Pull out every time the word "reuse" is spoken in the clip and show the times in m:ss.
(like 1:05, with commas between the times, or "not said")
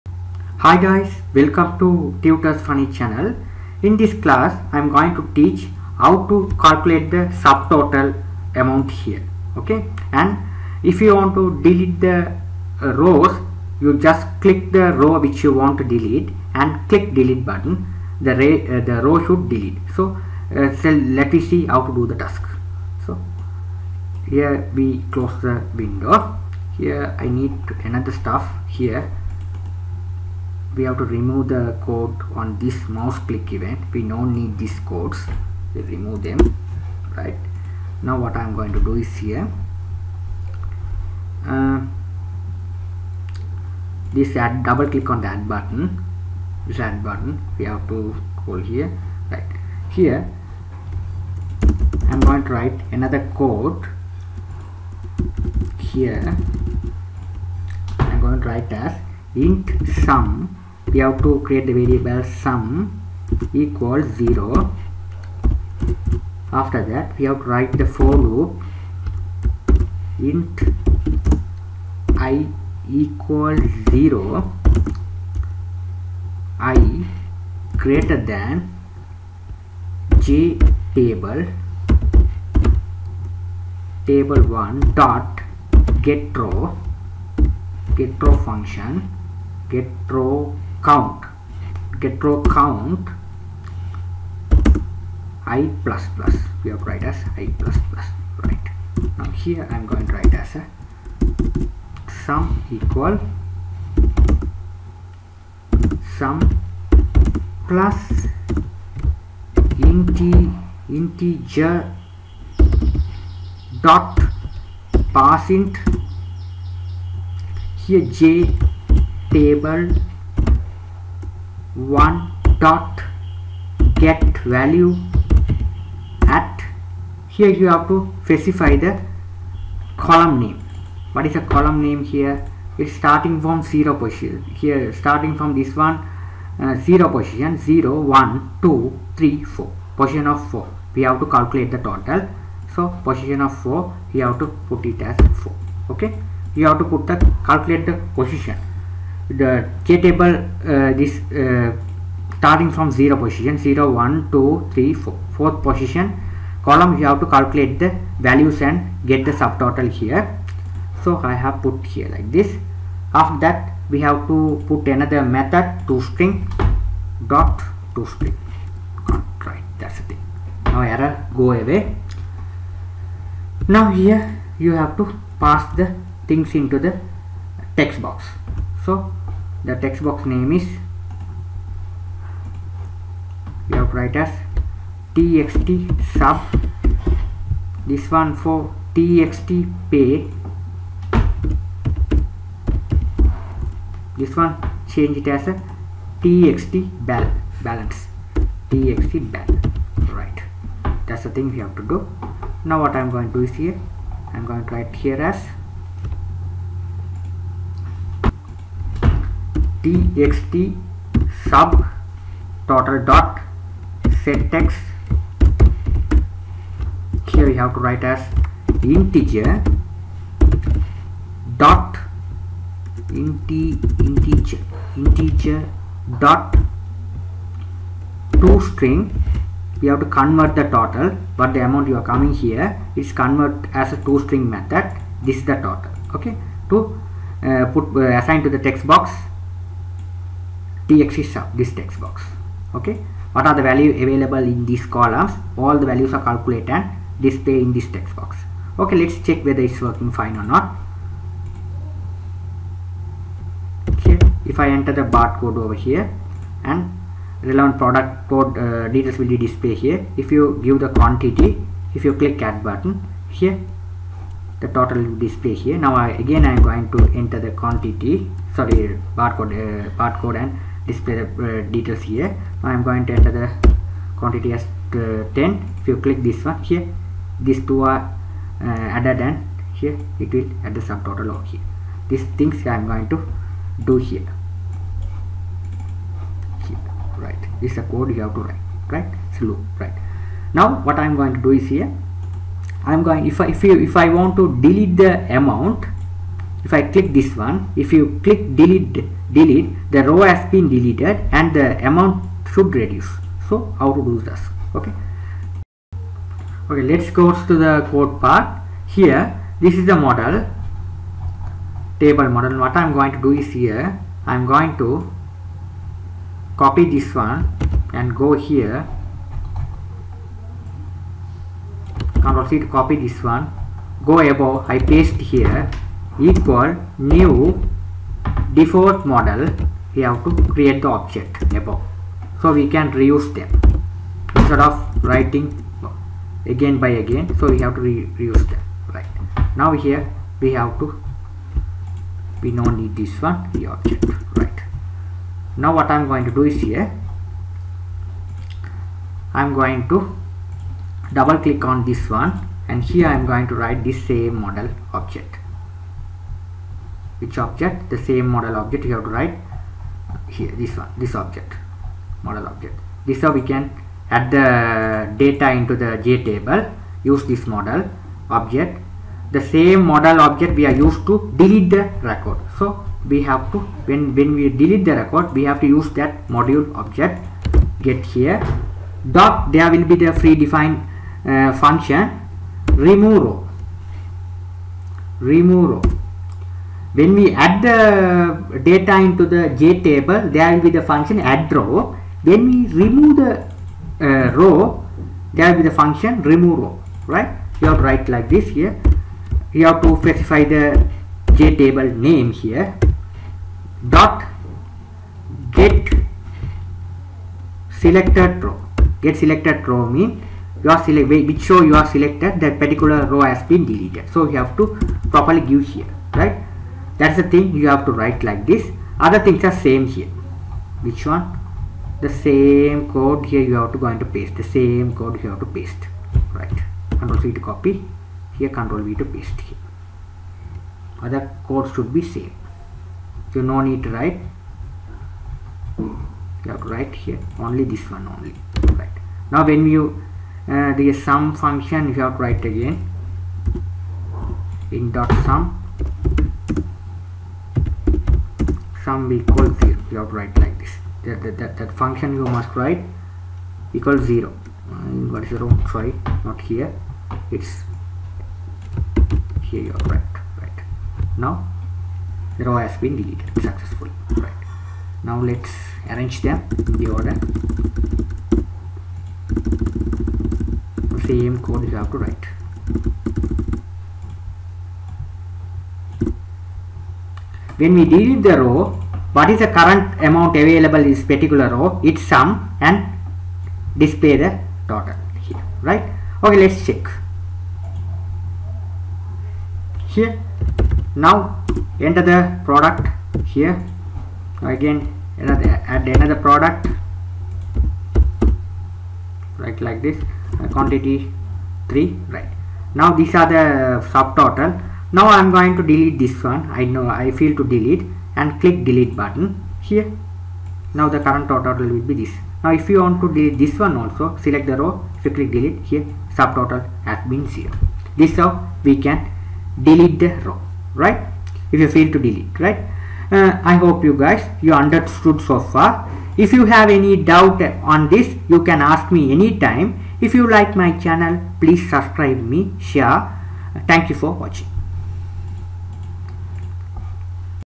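5:32, 5:38.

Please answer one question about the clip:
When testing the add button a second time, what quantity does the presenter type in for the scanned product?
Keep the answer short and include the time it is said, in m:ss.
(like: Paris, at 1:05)
10, at 4:35.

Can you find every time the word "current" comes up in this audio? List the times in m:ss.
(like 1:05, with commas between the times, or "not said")
7:59, 8:31.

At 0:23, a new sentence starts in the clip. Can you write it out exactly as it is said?
So here we close the window.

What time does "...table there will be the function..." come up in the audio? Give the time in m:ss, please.
6:29.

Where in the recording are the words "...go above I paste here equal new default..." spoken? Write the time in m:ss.
5:24.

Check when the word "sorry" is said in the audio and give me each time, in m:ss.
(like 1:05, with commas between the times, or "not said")
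4:28, 7:35.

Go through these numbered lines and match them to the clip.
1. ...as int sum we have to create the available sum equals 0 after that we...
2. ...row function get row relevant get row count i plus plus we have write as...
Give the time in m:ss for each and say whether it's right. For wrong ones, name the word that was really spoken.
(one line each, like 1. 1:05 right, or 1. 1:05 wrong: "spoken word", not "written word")
1. 0:58 wrong: "variable", not "available"
2. 1:28 wrong: "count", not "relevant".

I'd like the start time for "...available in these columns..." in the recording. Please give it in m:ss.
4:04.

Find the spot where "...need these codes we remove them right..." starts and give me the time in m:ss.
0:34.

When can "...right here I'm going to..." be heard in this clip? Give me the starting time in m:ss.
0:49.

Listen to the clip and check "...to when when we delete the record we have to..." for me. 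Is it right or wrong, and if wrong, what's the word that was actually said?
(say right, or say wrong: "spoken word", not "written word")
right.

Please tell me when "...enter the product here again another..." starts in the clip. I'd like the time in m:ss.
8:11.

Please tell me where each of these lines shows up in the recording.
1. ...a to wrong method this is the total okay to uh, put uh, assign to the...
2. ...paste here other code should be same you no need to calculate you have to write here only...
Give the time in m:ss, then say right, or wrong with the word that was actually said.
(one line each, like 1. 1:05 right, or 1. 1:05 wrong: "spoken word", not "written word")
1. 3:53 wrong: "string", not "wrong"
2. 7:09 wrong: "write", not "calculate".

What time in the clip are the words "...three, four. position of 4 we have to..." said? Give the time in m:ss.
2:19.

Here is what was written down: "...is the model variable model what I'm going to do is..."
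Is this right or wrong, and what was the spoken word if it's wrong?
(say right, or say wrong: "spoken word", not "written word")
wrong: "table", not "variable".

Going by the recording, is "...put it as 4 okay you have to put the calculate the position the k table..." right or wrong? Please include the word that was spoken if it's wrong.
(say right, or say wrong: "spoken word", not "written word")
right.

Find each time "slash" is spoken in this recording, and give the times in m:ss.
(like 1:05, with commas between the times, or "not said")
not said.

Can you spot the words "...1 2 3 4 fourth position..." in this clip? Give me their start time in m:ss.
2:33.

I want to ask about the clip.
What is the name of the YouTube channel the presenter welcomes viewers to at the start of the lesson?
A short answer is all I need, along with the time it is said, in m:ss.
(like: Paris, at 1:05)
Tutus Funny, at 0:02.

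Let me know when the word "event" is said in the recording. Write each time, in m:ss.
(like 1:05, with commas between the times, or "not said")
0:33.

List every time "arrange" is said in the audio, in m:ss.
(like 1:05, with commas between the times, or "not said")
7:45.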